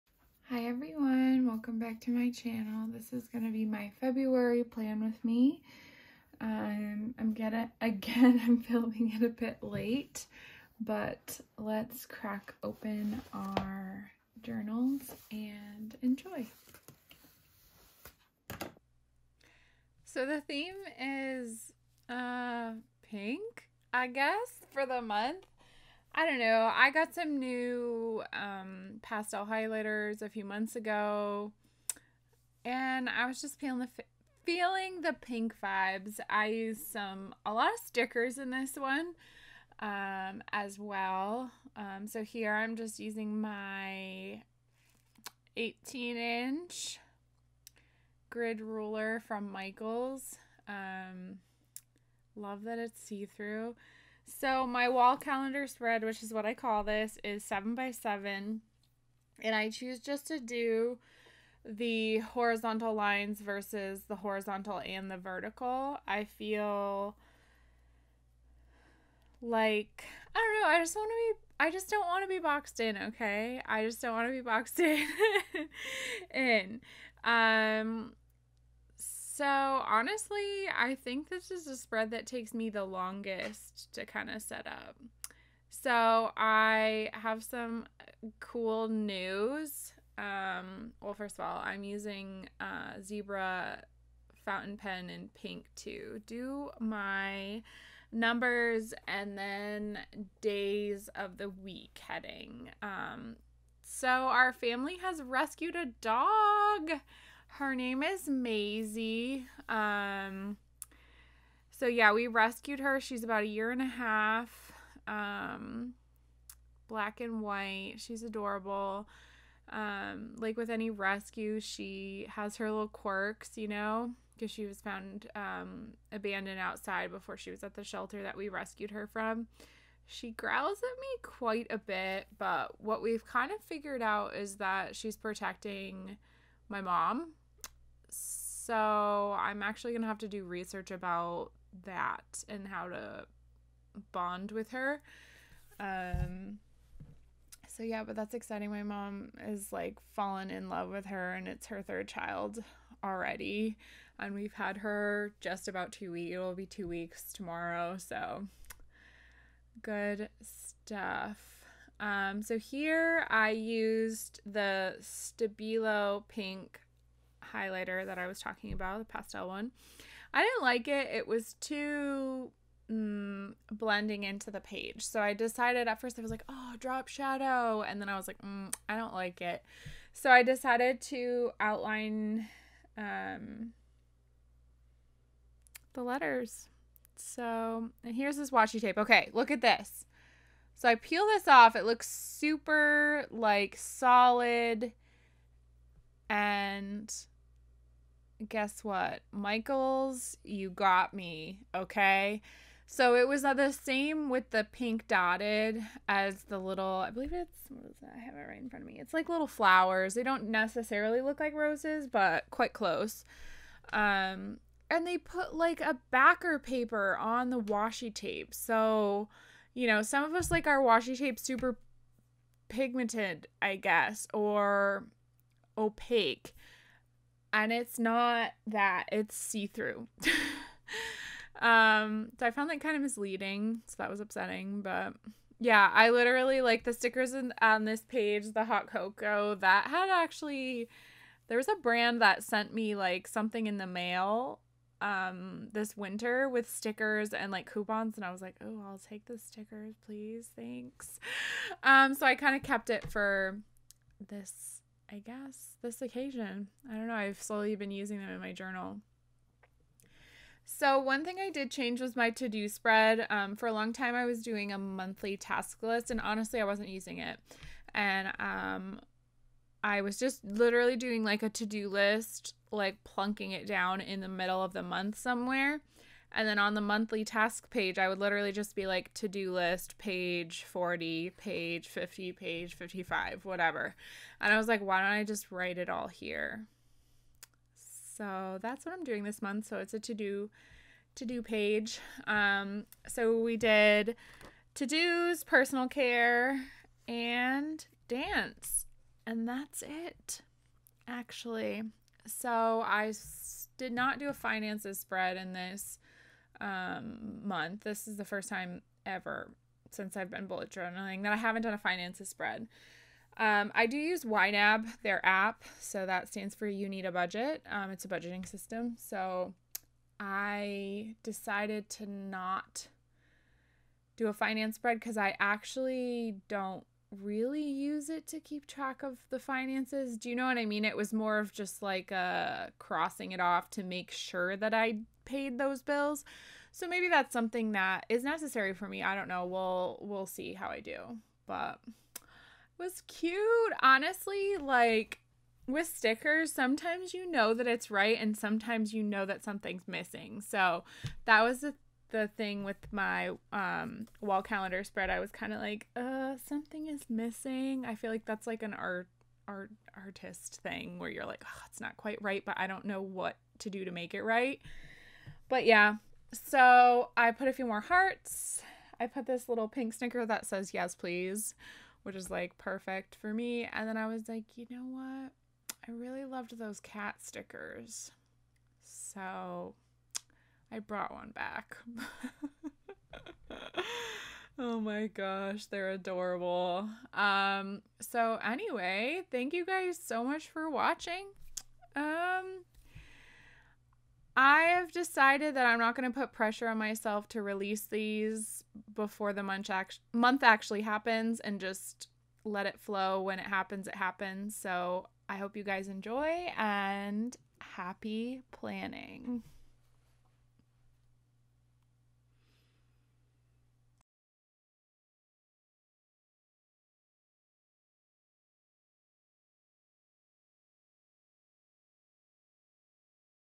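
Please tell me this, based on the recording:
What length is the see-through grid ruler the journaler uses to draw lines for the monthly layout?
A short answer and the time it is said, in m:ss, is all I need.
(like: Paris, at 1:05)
18 inch, at 0:45.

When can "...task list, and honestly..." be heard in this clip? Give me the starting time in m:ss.
4:25.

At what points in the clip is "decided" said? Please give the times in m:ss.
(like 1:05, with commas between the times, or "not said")
2:55, 3:00, 5:21, 6:34.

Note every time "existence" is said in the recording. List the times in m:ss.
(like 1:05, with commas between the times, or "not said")
not said.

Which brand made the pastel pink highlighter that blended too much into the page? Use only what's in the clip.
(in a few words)
Stabilo.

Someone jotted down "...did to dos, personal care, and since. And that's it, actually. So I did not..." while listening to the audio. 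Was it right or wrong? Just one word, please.
wrong.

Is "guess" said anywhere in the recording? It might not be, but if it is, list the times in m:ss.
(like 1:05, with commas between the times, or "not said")
0:24, 3:18, 3:43, 4:15.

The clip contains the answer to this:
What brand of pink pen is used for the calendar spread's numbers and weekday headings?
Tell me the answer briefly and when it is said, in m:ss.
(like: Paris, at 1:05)
Zebra, at 1:33.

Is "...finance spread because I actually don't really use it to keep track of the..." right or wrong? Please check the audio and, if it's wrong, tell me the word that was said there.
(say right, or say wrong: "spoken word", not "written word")
right.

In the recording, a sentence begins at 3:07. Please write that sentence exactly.
So, and here's this washi tape.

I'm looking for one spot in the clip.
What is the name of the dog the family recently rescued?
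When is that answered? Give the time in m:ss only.
1:48.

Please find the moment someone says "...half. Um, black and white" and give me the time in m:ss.
1:53.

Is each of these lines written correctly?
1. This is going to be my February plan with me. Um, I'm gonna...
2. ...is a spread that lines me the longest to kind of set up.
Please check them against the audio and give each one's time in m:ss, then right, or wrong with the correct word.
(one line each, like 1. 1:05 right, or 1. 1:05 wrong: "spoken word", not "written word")
1. 0:02 right
2. 1:21 wrong: "takes", not "lines".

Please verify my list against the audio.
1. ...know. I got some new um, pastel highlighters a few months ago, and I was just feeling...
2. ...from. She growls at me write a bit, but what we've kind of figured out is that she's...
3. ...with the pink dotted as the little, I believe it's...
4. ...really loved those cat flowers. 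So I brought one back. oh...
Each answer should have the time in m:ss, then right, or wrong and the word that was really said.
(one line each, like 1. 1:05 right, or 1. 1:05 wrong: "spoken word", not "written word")
1. 0:26 right
2. 2:09 wrong: "quite", not "write"
3. 3:24 right
4. 6:15 wrong: "stickers", not "flowers".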